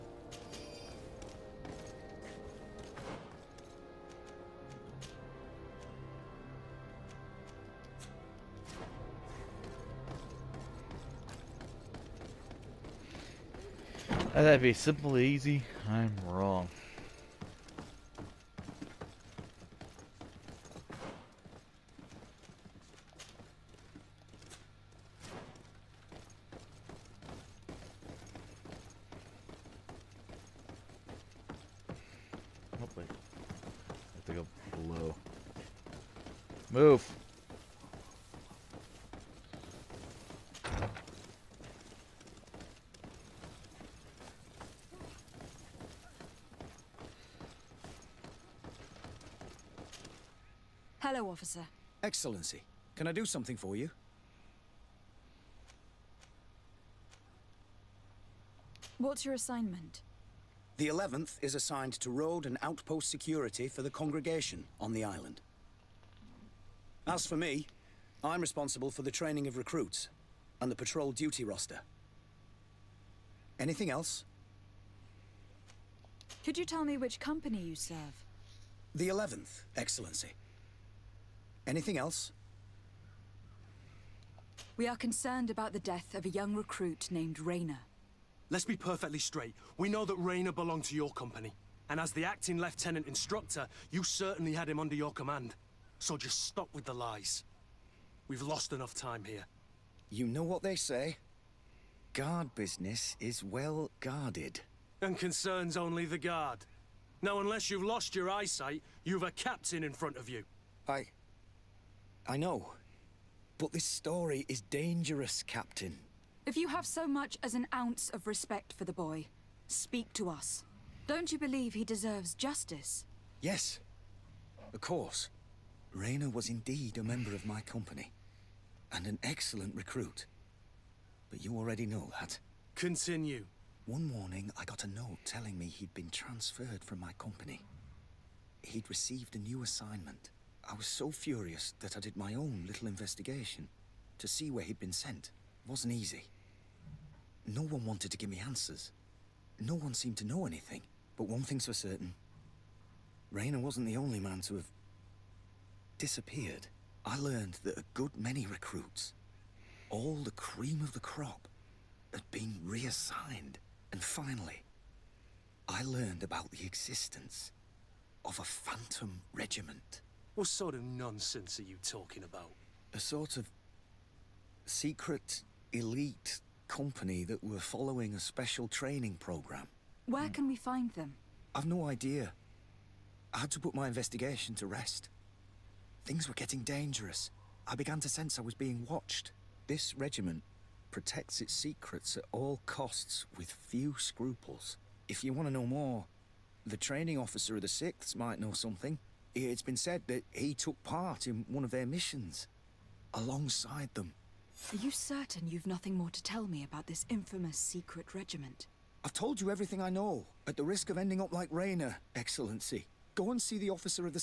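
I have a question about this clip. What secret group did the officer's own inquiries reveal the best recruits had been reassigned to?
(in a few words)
phantom regiment.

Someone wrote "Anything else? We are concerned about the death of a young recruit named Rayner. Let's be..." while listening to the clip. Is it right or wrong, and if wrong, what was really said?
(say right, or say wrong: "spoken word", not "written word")
right.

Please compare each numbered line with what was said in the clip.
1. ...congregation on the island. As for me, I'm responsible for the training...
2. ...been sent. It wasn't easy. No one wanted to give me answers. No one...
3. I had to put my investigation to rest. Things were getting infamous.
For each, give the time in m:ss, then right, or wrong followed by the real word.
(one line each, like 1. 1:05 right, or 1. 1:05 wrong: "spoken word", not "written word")
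1. 1:03 right
2. 2:24 right
3. 3:03 wrong: "dangerous", not "infamous".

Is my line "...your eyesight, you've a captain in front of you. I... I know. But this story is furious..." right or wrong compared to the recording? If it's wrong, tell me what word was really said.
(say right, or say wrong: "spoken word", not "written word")
wrong: "dangerous", not "furious".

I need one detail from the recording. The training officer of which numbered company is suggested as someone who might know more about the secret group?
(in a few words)
6th.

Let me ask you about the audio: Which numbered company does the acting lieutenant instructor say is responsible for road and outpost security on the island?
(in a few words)
11th.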